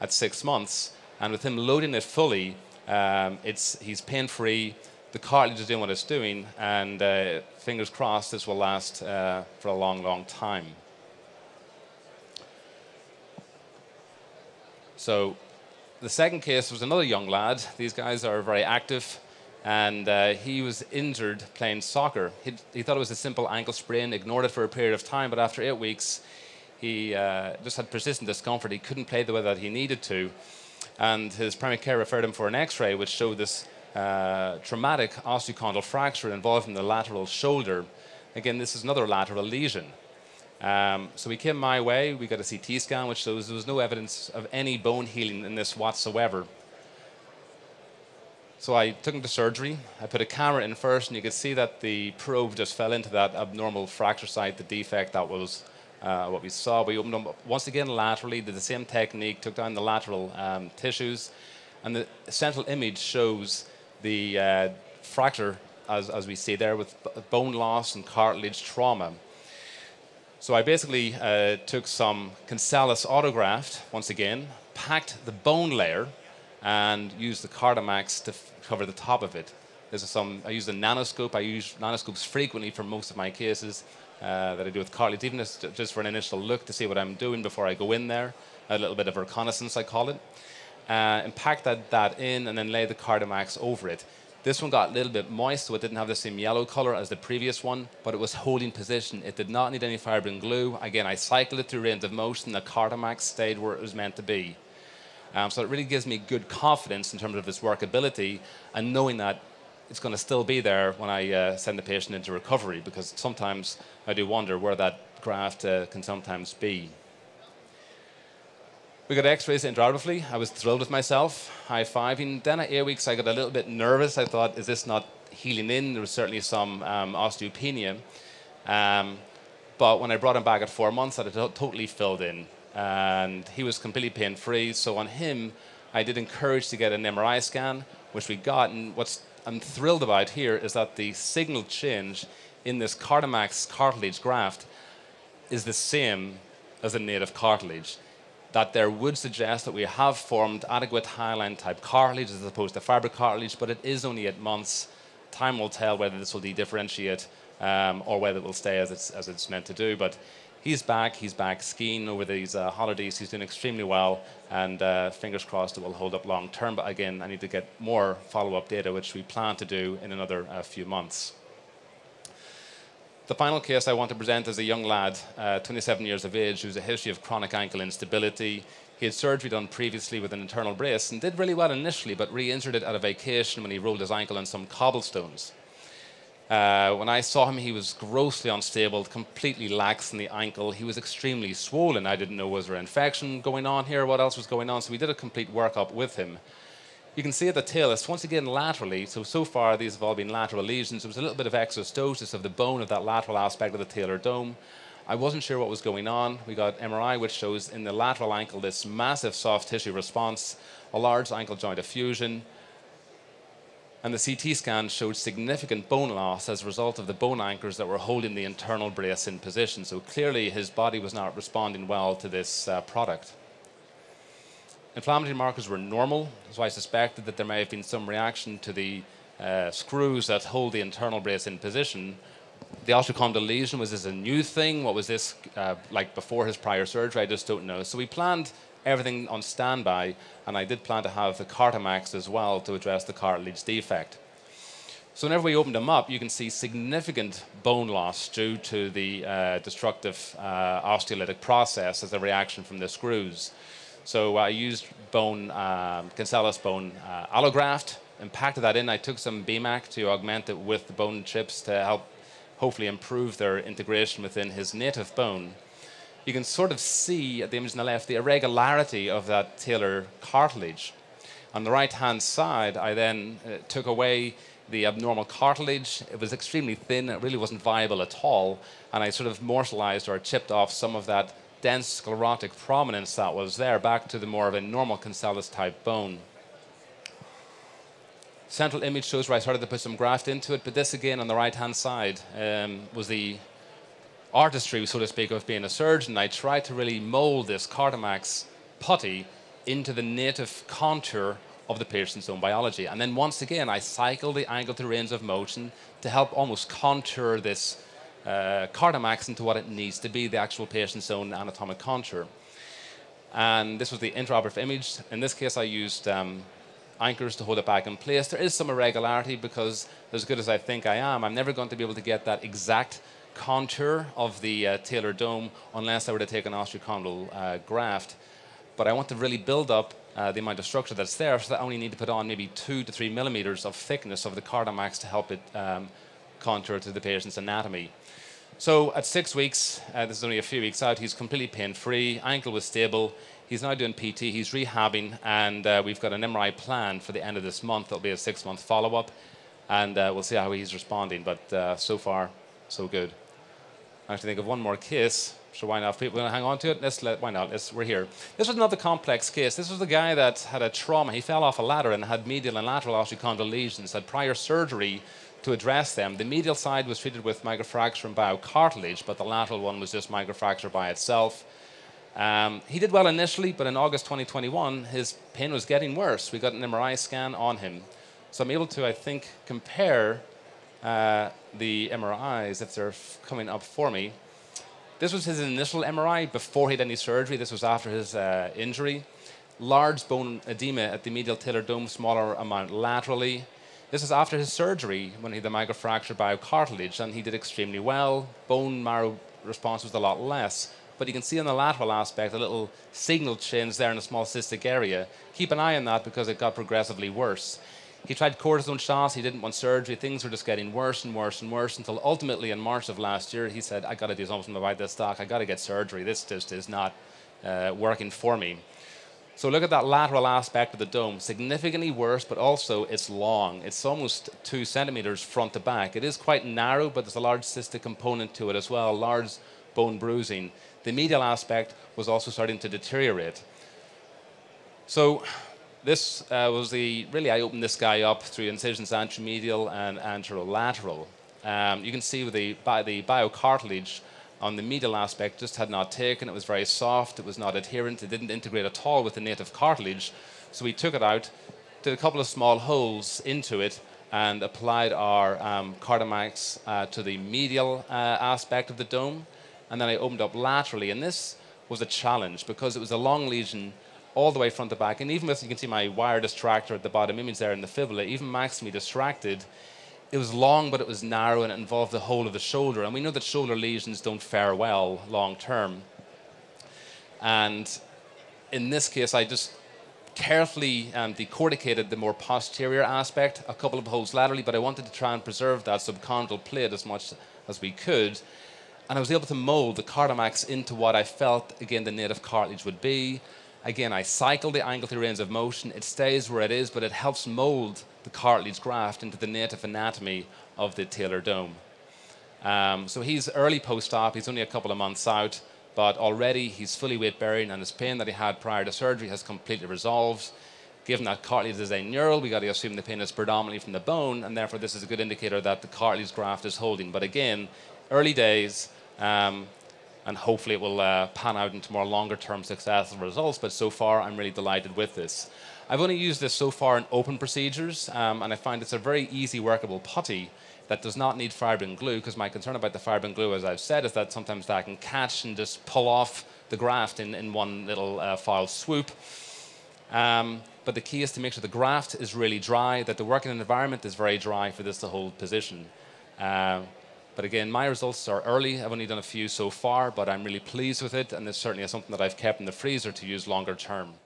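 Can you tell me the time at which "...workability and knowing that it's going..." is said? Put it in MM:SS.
01:47.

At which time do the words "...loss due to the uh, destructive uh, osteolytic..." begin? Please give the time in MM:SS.
04:07.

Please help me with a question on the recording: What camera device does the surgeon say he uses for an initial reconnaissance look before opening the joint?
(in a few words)
nanoscope.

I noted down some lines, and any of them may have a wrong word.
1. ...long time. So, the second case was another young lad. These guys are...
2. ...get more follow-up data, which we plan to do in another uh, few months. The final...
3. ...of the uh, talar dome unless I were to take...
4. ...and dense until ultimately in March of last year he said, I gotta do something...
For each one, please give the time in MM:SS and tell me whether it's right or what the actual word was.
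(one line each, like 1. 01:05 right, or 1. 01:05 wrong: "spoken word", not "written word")
1. 00:10 right
2. 02:47 right
3. 05:24 right
4. 06:51 wrong: "worse", not "dense".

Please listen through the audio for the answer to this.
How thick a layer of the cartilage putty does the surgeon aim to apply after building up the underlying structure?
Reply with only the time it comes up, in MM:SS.
05:32.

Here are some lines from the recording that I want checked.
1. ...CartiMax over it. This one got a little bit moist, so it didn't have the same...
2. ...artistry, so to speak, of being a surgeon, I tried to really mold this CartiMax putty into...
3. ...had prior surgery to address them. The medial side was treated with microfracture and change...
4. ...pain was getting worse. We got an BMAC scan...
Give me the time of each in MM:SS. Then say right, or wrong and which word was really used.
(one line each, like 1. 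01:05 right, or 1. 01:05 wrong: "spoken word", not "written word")
1. 01:32 right
2. 04:54 right
3. 06:03 wrong: "biocartilage", not "change"
4. 06:15 wrong: "MRI", not "BMAC".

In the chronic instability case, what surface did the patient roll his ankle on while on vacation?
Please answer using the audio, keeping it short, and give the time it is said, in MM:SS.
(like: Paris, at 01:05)
cobblestones, at 03:04.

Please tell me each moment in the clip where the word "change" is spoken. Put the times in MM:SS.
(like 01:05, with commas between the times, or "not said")
02:21, 06:43.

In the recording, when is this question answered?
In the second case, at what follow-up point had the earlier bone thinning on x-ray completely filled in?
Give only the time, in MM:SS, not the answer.
02:10.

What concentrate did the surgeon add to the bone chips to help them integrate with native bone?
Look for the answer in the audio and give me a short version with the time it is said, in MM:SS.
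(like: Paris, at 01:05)
BMAC, at 04:19.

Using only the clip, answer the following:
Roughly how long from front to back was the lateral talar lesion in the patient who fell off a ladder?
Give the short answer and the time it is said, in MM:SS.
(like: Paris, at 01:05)
2 centimeters, at 07:04.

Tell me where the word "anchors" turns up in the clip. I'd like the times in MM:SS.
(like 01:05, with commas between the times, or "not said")
03:37, 05:16.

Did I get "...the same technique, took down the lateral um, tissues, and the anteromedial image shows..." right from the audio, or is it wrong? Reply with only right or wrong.
wrong.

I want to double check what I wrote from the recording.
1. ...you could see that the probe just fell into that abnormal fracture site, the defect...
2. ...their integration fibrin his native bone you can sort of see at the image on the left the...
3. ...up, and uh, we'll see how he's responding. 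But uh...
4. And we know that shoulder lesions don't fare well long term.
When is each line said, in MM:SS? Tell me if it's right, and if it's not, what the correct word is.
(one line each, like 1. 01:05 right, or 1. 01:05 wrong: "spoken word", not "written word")
1. 00:51 right
2. 04:23 wrong: "within", not "fibrin"
3. 05:48 right
4. 07:52 right.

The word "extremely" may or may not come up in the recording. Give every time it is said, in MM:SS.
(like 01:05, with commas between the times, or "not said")
02:43, 03:10, 04:36, 06:37.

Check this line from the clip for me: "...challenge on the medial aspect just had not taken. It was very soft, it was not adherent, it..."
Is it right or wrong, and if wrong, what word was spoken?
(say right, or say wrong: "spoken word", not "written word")
wrong: "biocartilage", not "challenge".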